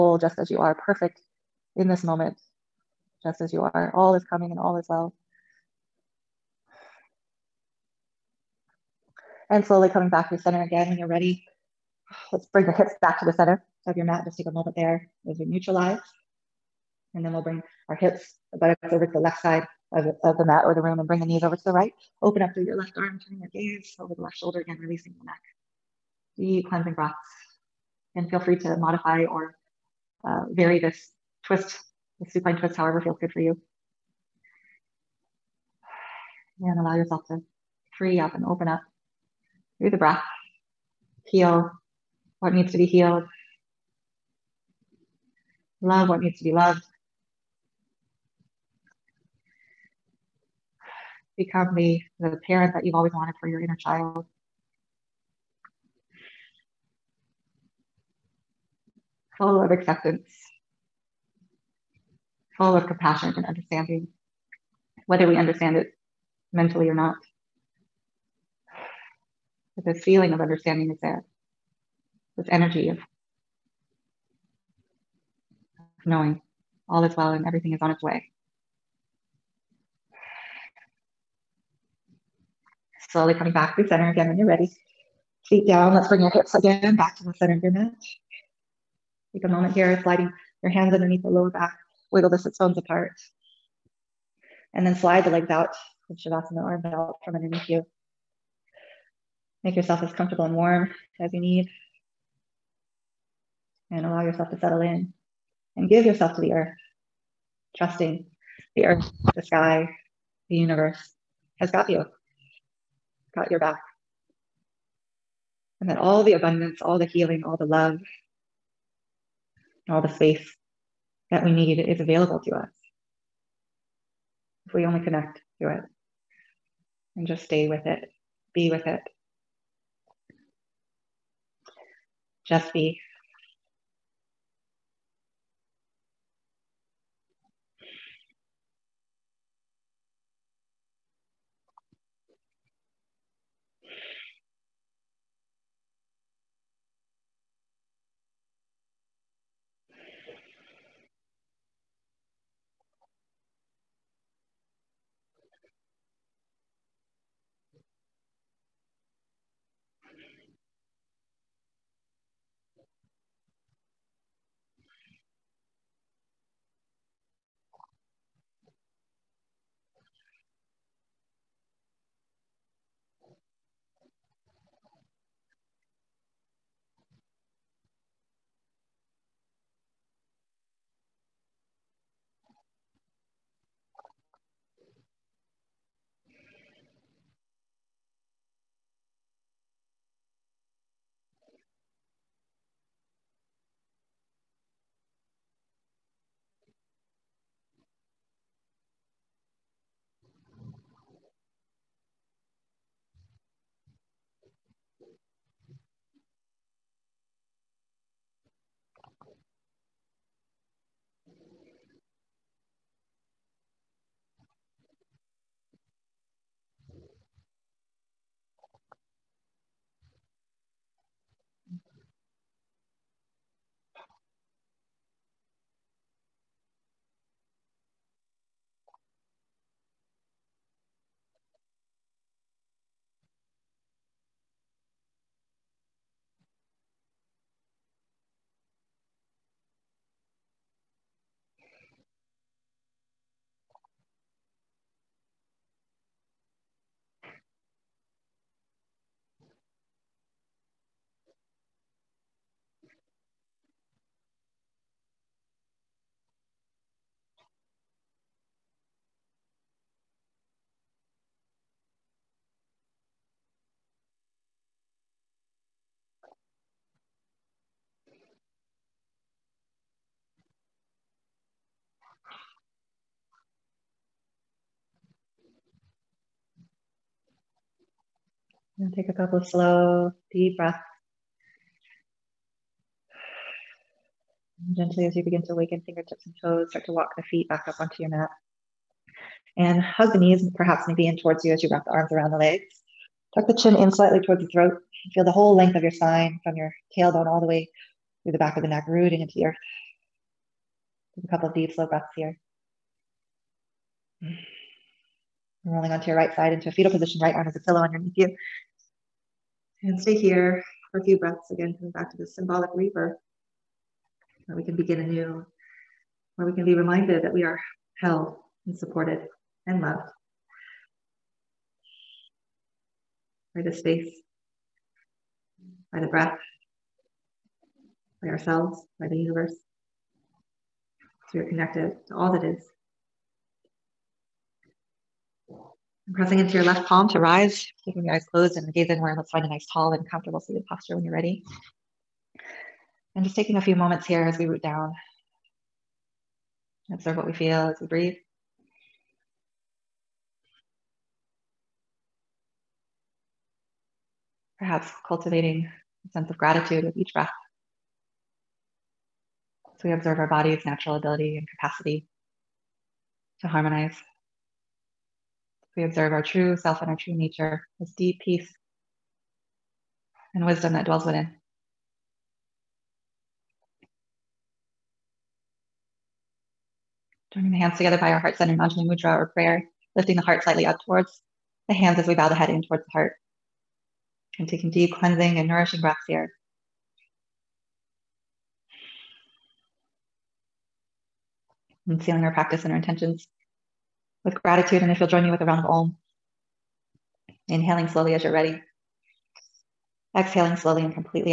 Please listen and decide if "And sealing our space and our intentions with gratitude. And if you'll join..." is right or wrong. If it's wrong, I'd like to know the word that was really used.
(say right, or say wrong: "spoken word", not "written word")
wrong: "practice", not "space".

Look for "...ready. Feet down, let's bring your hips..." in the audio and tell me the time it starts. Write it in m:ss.
1:24.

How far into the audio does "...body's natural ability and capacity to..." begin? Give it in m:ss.
6:00.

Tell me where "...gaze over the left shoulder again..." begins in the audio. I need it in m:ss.
0:23.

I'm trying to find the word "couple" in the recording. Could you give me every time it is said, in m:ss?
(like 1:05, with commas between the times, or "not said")
4:39, 5:01.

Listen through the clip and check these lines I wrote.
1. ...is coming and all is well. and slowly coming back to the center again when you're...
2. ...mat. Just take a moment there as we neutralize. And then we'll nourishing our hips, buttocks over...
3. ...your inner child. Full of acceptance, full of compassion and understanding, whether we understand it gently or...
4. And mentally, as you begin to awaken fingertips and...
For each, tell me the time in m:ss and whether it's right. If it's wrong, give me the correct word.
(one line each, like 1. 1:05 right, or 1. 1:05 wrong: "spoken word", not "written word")
1. 0:04 right
2. 0:14 wrong: "bring", not "nourishing"
3. 0:53 wrong: "mentally", not "gently"
4. 4:44 wrong: "gently", not "mentally".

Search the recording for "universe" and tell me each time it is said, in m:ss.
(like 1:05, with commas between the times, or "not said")
1:50, 5:29.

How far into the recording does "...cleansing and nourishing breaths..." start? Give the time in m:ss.
6:24.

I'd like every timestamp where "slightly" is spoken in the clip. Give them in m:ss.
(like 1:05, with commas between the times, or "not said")
4:53, 6:20.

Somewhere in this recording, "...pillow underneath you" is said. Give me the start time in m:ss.
5:07.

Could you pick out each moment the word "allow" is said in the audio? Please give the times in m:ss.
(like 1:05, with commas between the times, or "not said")
0:36, 1:44.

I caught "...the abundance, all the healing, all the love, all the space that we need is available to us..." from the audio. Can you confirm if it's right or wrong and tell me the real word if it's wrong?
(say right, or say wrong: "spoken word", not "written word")
right.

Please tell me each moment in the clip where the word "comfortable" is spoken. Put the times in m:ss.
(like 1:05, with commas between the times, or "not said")
1:40, 5:40.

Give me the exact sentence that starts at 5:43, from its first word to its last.
And just taking a few moments here as we root down.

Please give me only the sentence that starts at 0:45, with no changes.
Love what needs to be loved.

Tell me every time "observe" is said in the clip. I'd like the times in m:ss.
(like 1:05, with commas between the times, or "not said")
5:46, 5:59, 6:05.